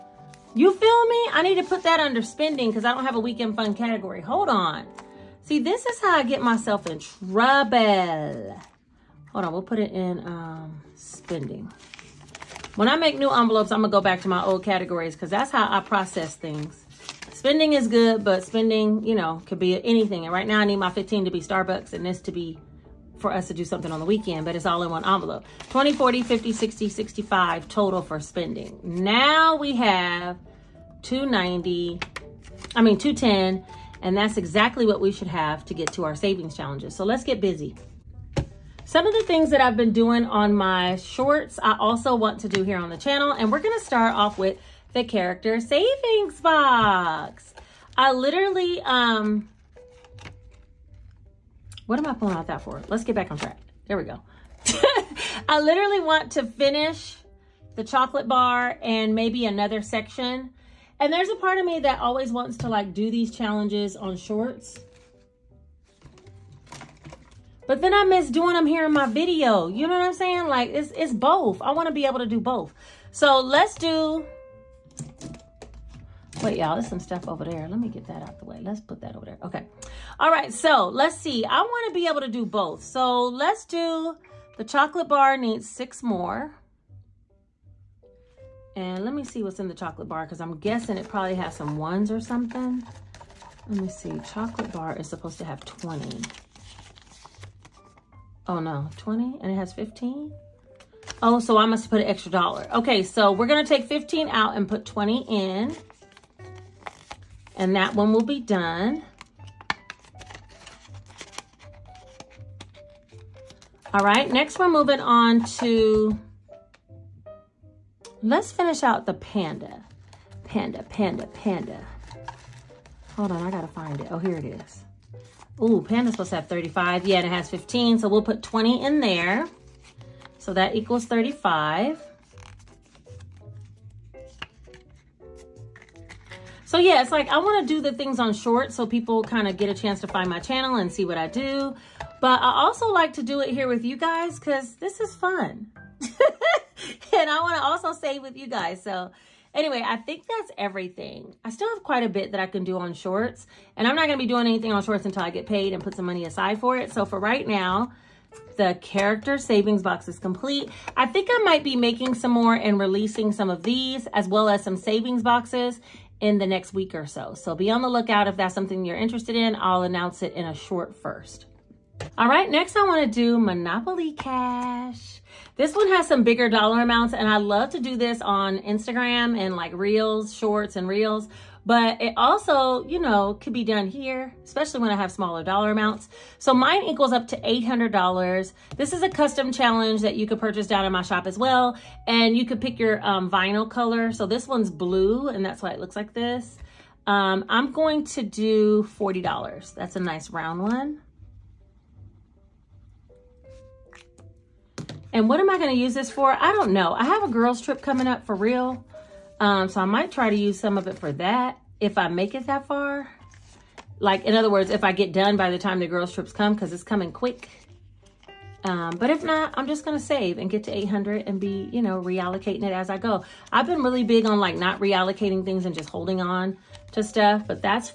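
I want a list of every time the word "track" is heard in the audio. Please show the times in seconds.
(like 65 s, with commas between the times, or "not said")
53 s.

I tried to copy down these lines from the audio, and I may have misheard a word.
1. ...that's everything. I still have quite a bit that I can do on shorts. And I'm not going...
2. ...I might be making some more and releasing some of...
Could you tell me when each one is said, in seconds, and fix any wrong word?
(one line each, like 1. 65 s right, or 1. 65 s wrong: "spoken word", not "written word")
1. 150 s right
2. 161 s right.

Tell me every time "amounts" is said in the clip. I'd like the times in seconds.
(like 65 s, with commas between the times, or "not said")
176 s, 185 s.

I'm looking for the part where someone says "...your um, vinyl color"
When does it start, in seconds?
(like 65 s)
192 s.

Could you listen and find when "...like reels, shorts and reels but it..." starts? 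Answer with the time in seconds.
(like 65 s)
179 s.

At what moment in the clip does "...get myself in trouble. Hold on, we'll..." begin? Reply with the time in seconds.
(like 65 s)
6 s.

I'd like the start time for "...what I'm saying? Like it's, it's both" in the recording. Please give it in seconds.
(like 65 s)
69 s.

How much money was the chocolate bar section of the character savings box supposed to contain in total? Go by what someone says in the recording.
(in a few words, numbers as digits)
20.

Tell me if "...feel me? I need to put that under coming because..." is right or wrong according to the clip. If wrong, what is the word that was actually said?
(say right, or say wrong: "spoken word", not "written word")
wrong: "spending", not "coming".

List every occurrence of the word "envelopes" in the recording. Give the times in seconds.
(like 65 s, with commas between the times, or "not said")
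13 s, 25 s.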